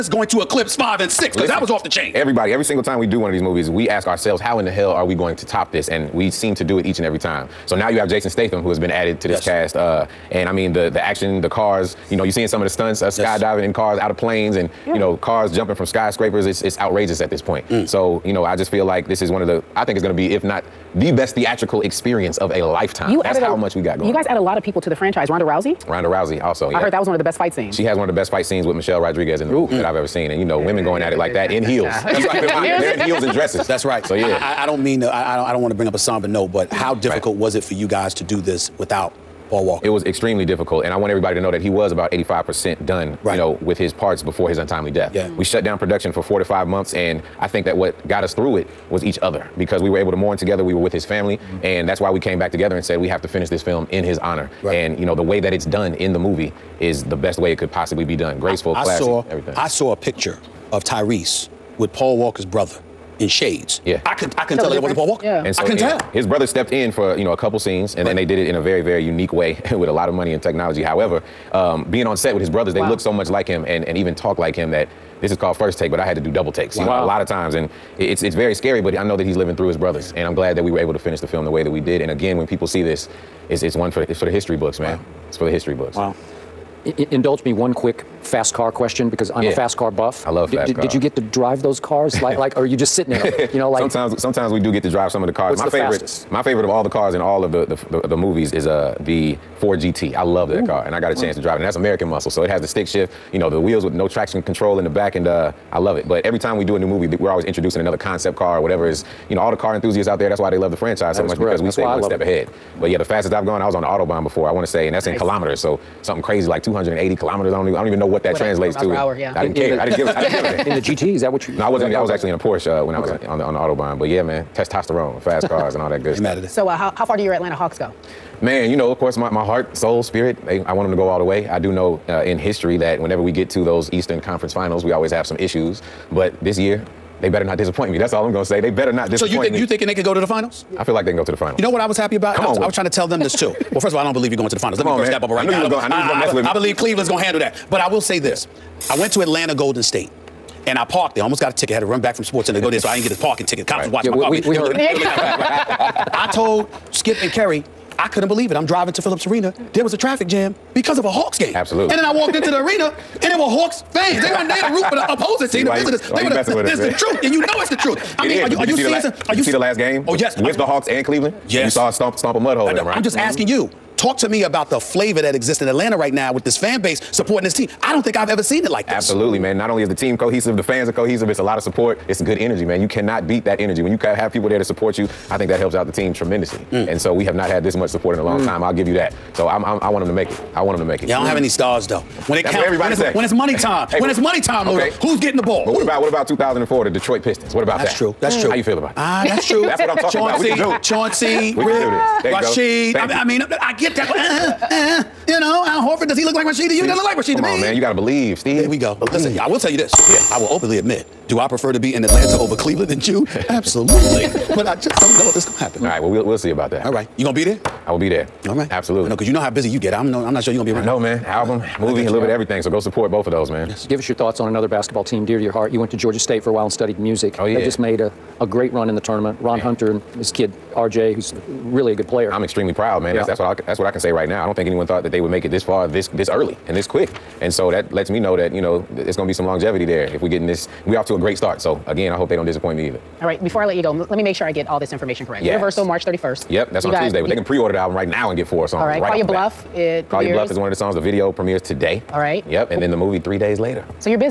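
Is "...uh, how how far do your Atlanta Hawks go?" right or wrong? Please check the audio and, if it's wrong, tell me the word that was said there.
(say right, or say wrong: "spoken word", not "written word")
right.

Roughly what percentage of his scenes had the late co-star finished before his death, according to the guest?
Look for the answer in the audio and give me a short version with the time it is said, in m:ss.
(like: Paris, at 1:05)
85%, at 0:42.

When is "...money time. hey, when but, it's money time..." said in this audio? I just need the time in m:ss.
3:13.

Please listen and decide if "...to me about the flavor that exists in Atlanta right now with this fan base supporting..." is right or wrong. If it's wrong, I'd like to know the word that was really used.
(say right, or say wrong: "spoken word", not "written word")
right.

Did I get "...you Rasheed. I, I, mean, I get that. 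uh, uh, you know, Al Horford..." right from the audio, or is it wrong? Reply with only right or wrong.
right.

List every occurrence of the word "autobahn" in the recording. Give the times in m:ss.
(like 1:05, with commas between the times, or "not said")
1:53, 2:03.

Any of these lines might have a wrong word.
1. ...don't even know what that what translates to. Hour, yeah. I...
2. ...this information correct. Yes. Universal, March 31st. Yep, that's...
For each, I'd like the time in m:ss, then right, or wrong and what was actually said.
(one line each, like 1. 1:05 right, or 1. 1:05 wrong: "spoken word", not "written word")
1. 1:57 right
2. 4:04 right.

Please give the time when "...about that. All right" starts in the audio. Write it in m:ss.
3:36.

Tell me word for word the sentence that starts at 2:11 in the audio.
I do know uh, in history that whenever we get to those Eastern Conference finals, we always have some issues.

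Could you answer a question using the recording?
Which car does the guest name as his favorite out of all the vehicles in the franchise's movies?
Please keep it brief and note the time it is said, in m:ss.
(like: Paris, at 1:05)
Ford GT, at 1:39.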